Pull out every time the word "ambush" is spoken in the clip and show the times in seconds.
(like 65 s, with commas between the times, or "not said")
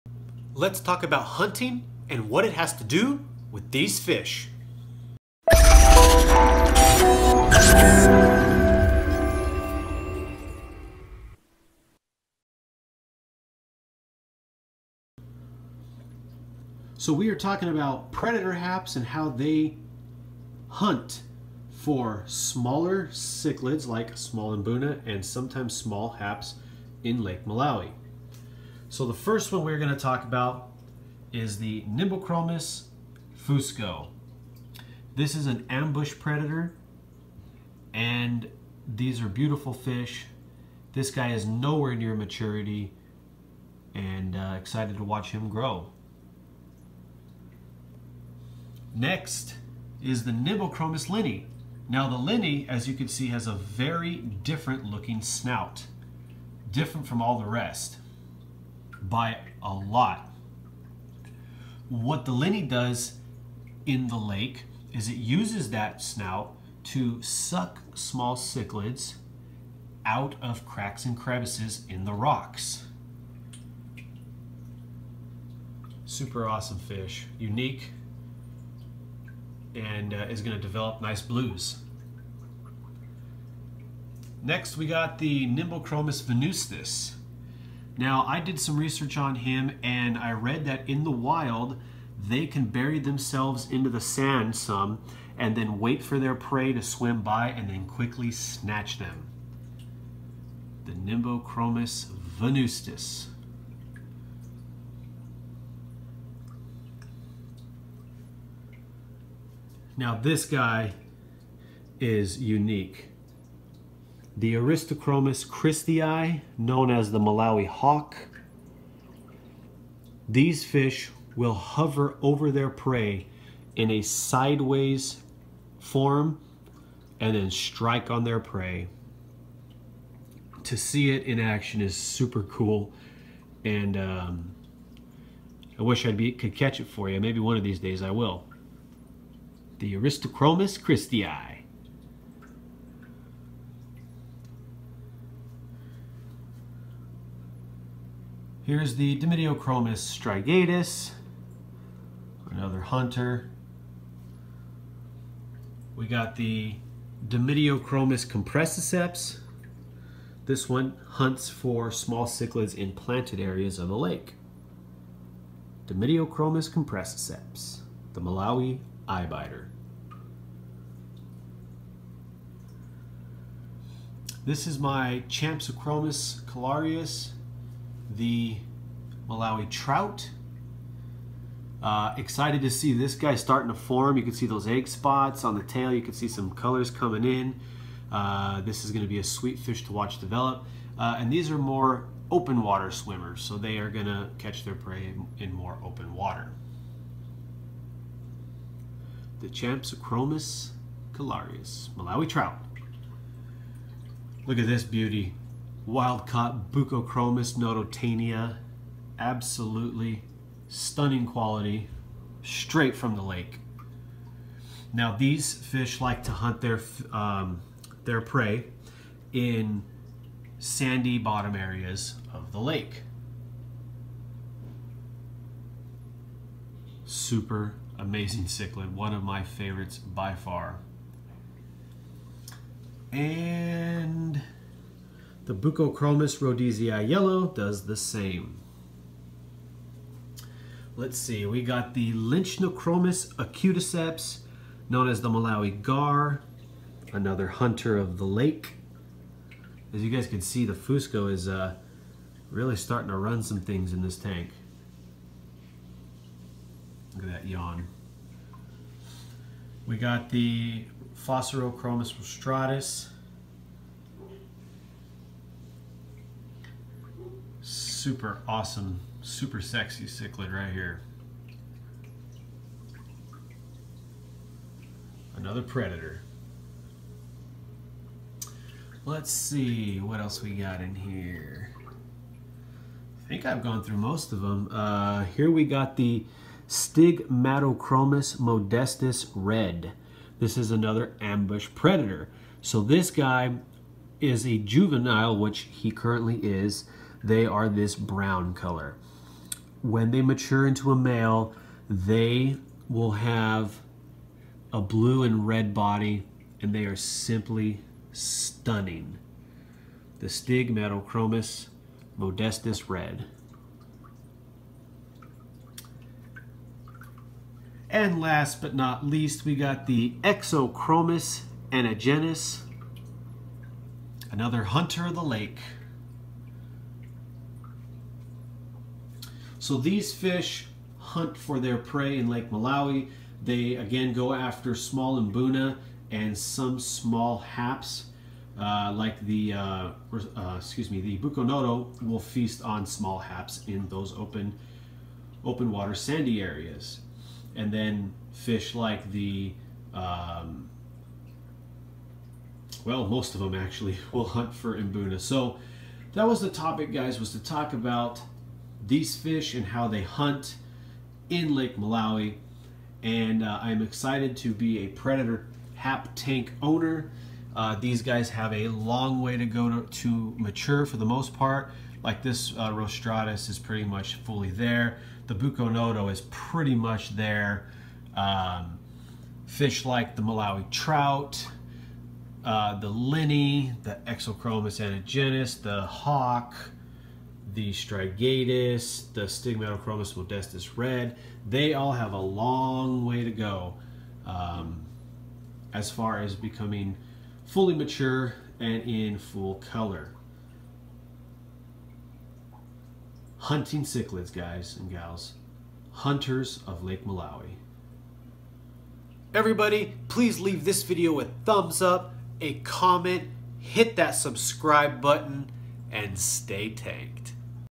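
35 s, 291 s.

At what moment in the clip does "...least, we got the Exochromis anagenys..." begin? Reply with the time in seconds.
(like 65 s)
319 s.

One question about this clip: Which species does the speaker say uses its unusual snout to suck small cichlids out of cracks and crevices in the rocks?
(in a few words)
Nimbochromis linni.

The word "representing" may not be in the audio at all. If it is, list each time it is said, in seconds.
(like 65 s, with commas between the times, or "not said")
not said.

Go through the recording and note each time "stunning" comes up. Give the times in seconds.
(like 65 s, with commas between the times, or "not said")
210 s, 308 s.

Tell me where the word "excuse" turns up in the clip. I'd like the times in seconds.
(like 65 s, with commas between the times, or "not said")
340 s.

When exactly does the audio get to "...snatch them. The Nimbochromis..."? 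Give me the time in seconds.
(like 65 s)
98 s.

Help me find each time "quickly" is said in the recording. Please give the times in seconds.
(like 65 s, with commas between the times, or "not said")
97 s.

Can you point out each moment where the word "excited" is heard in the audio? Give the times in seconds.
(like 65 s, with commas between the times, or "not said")
44 s, 182 s, 363 s.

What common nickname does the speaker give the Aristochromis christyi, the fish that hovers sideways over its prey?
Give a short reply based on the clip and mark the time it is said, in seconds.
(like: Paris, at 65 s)
Malawi hawk, at 117 s.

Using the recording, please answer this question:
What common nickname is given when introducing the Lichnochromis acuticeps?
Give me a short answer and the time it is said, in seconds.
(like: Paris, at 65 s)
Malawi gar, at 245 s.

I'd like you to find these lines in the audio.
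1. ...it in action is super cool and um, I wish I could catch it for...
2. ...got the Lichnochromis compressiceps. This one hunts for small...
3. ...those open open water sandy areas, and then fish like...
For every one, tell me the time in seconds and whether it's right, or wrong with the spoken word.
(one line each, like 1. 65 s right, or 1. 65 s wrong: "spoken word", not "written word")
1. 131 s right
2. 156 s wrong: "Dimidiochromis", not "Lichnochromis"
3. 343 s right.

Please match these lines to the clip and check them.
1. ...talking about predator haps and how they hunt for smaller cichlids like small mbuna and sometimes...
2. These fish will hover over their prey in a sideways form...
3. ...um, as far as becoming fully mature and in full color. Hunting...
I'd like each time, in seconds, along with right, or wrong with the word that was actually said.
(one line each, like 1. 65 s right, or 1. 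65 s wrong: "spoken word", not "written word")
1. 17 s right
2. 120 s right
3. 394 s right.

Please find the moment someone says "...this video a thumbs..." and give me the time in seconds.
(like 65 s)
410 s.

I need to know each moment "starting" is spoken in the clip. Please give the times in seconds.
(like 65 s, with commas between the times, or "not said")
183 s, 252 s.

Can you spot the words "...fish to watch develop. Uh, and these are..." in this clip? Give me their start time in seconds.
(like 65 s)
189 s.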